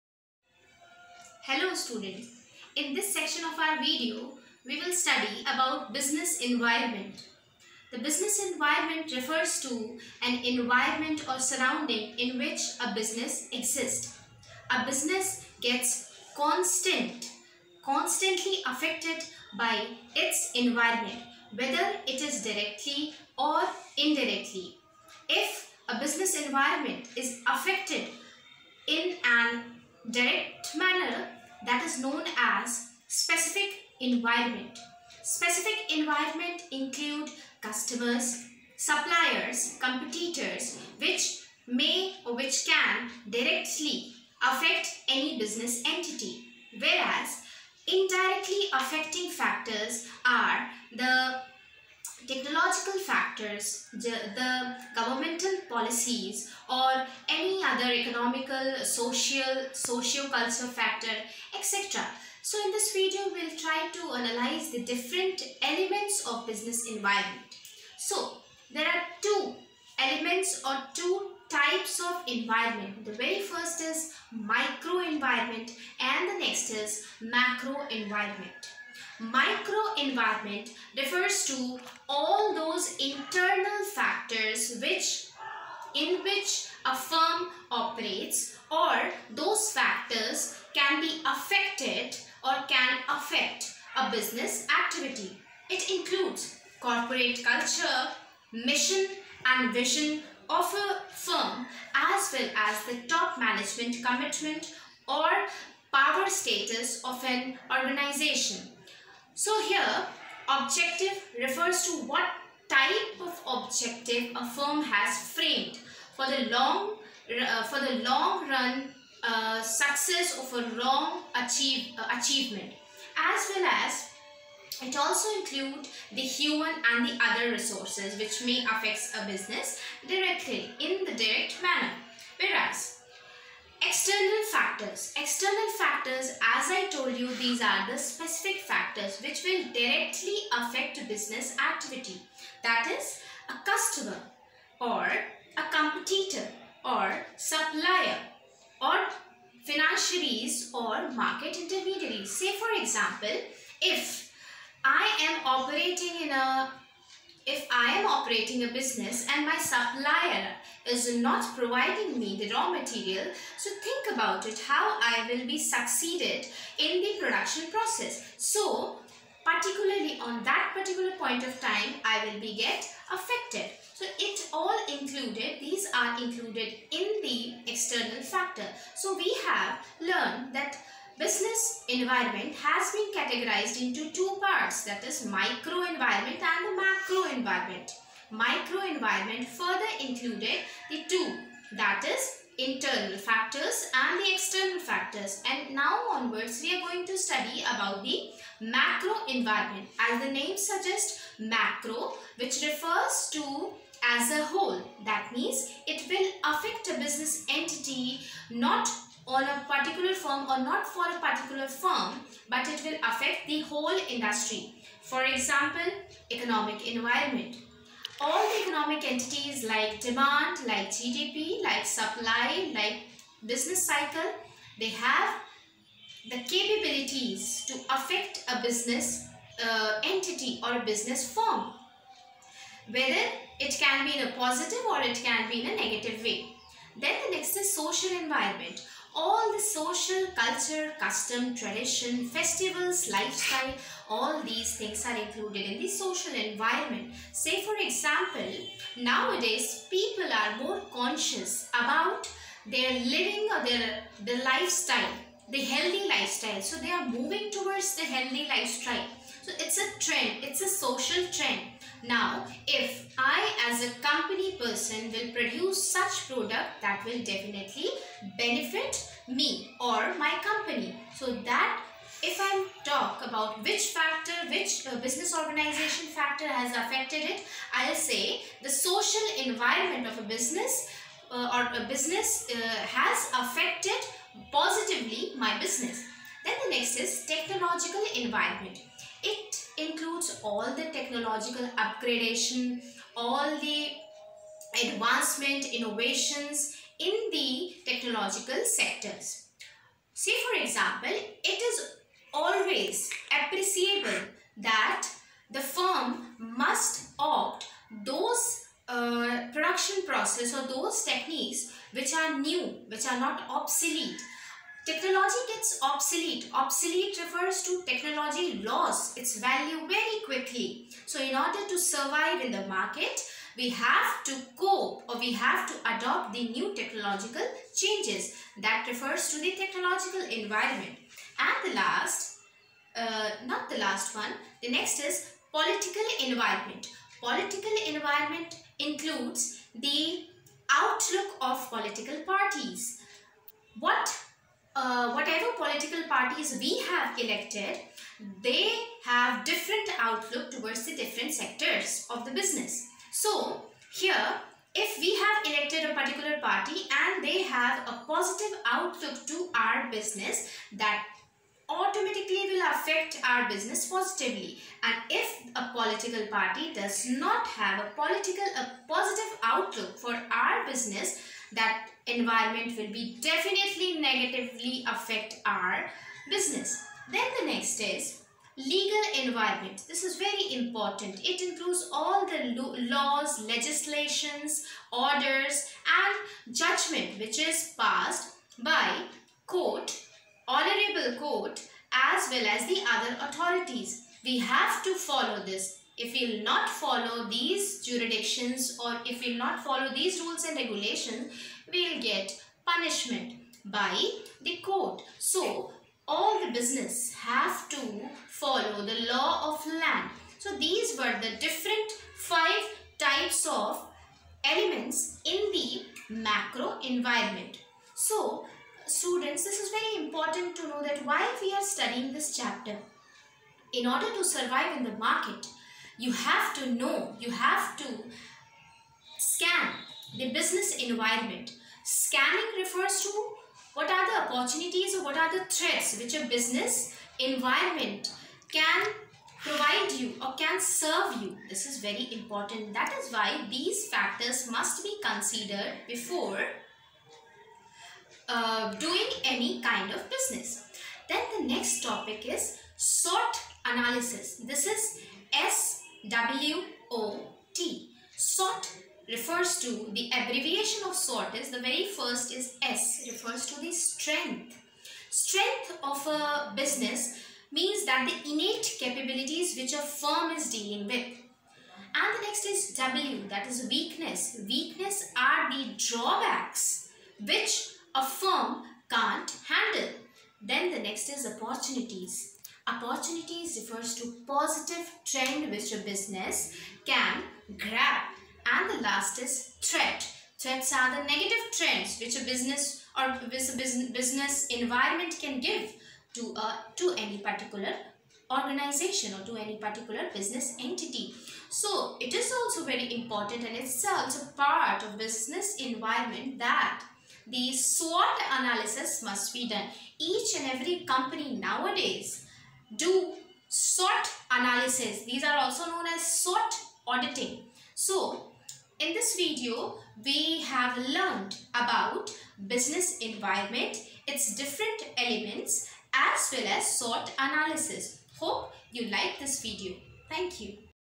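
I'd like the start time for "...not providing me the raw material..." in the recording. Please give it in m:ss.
2:41.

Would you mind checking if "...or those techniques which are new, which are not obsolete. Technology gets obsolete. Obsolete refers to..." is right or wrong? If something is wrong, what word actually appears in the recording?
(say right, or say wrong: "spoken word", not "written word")
right.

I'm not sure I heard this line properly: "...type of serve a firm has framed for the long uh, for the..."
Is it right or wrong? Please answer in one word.
wrong.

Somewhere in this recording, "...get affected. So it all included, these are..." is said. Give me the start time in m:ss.
2:52.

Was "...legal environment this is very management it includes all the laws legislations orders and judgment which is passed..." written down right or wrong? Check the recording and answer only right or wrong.
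wrong.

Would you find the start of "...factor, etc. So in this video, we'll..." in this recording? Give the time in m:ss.
1:00.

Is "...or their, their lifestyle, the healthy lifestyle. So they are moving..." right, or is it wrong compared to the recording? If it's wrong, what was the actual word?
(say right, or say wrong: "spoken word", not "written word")
right.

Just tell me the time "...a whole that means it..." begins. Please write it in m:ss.
3:24.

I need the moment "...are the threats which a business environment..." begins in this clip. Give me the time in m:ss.
7:15.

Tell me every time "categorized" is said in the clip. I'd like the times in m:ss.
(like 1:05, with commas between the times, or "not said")
3:03.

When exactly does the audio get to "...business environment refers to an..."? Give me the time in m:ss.
0:07.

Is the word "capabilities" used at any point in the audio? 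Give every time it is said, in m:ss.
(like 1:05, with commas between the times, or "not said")
3:46, 7:48.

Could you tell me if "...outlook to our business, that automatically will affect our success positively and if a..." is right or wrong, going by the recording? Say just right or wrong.
wrong.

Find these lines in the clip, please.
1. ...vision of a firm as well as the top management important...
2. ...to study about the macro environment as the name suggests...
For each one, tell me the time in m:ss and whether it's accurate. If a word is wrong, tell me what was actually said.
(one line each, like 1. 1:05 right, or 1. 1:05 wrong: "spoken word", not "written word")
1. 1:39 wrong: "commitment", not "important"
2. 3:17 right.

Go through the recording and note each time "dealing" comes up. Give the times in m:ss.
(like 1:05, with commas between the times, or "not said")
7:50.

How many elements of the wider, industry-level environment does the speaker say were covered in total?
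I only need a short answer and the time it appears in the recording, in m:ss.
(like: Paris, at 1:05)
5, at 6:52.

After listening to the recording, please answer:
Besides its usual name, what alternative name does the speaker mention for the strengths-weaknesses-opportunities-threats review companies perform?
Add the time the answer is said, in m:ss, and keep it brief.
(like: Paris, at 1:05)
SWOT auditing, at 8:36.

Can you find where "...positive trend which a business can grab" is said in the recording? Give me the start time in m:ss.
8:04.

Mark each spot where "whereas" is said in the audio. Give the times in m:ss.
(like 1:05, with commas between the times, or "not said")
0:46, 2:12.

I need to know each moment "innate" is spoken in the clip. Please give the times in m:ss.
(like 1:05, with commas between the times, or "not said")
7:48.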